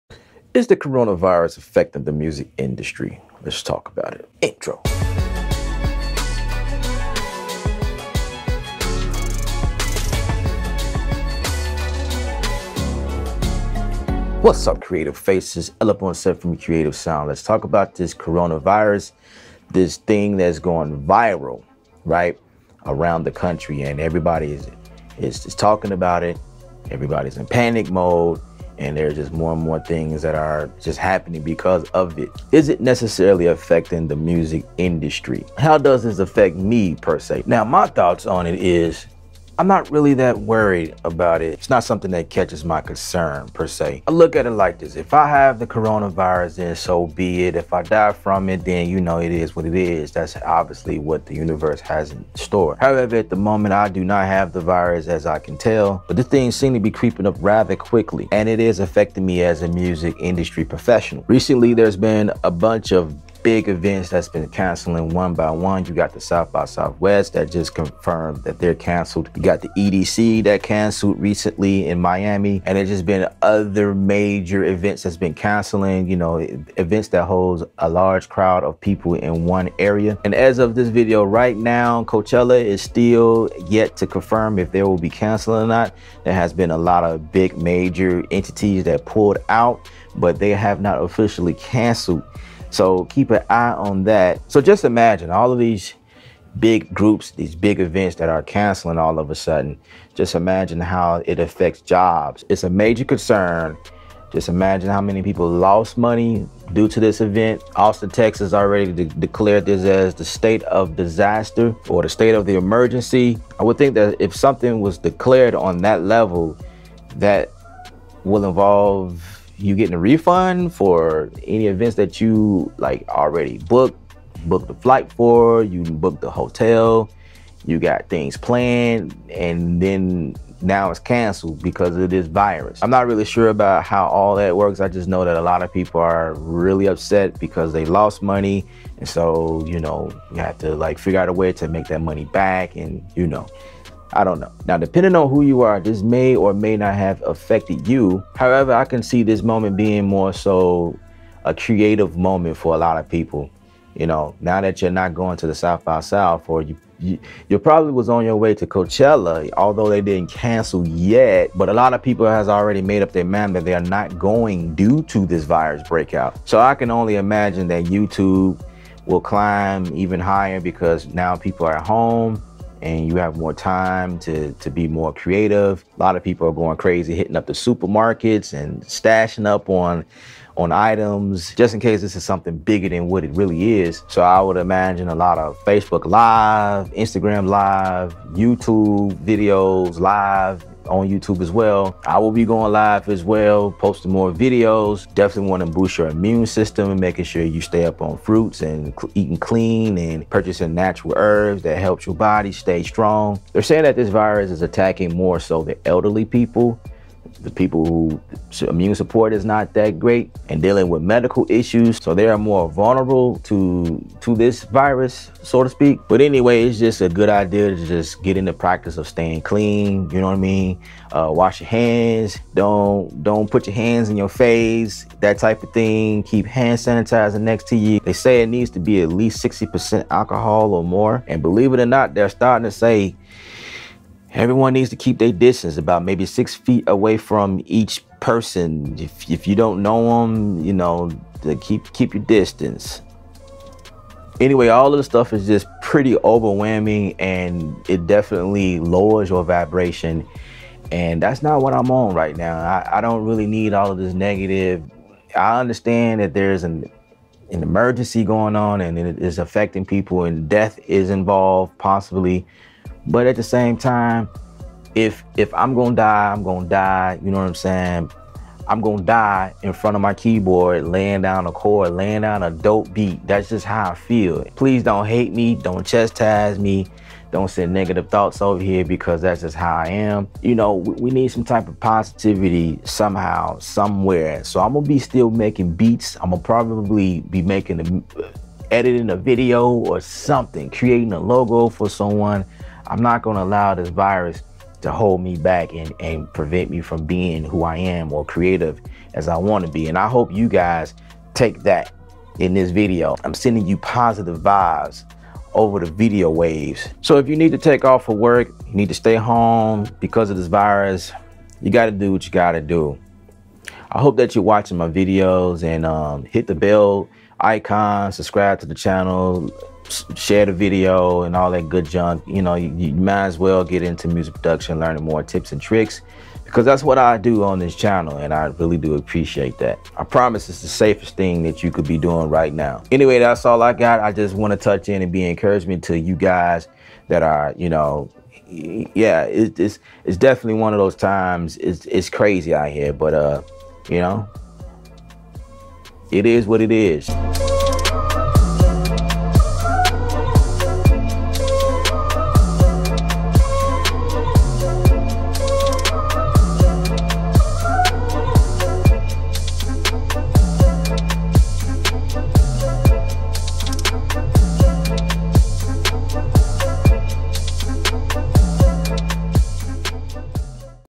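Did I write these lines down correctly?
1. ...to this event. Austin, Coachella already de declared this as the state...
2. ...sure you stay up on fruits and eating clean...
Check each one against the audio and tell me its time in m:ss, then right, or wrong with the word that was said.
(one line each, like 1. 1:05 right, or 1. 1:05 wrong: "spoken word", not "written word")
1. 1:46 wrong: "Texas", not "Coachella"
2. 3:17 right.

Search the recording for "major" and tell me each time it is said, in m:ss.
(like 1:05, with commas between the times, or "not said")
1:13, 1:27, 1:42.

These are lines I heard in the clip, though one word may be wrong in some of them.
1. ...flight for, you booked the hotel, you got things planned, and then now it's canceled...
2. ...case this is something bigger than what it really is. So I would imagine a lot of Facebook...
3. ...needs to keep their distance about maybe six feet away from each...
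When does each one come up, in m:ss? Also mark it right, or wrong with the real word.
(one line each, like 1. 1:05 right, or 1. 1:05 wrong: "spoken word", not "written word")
1. 2:04 right
2. 3:01 right
3. 3:54 right.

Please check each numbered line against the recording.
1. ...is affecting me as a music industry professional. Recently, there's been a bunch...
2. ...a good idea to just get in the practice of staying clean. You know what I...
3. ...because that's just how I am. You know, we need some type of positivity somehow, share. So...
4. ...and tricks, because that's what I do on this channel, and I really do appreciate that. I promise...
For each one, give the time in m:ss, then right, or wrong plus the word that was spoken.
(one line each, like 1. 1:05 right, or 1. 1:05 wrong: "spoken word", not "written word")
1. 0:58 right
2. 3:37 right
3. 4:38 wrong: "somewhere", not "share"
4. 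5:25 right.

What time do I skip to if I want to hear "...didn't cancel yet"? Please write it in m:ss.
2:40.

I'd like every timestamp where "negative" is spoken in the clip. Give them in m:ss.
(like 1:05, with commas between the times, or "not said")
4:14, 4:37.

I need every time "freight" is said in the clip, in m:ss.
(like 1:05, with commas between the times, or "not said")
not said.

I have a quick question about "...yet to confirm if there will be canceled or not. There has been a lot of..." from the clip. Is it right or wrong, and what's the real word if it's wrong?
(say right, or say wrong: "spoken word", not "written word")
right.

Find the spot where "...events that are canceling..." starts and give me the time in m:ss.
1:37.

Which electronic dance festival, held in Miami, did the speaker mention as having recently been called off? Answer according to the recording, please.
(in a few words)
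EDC.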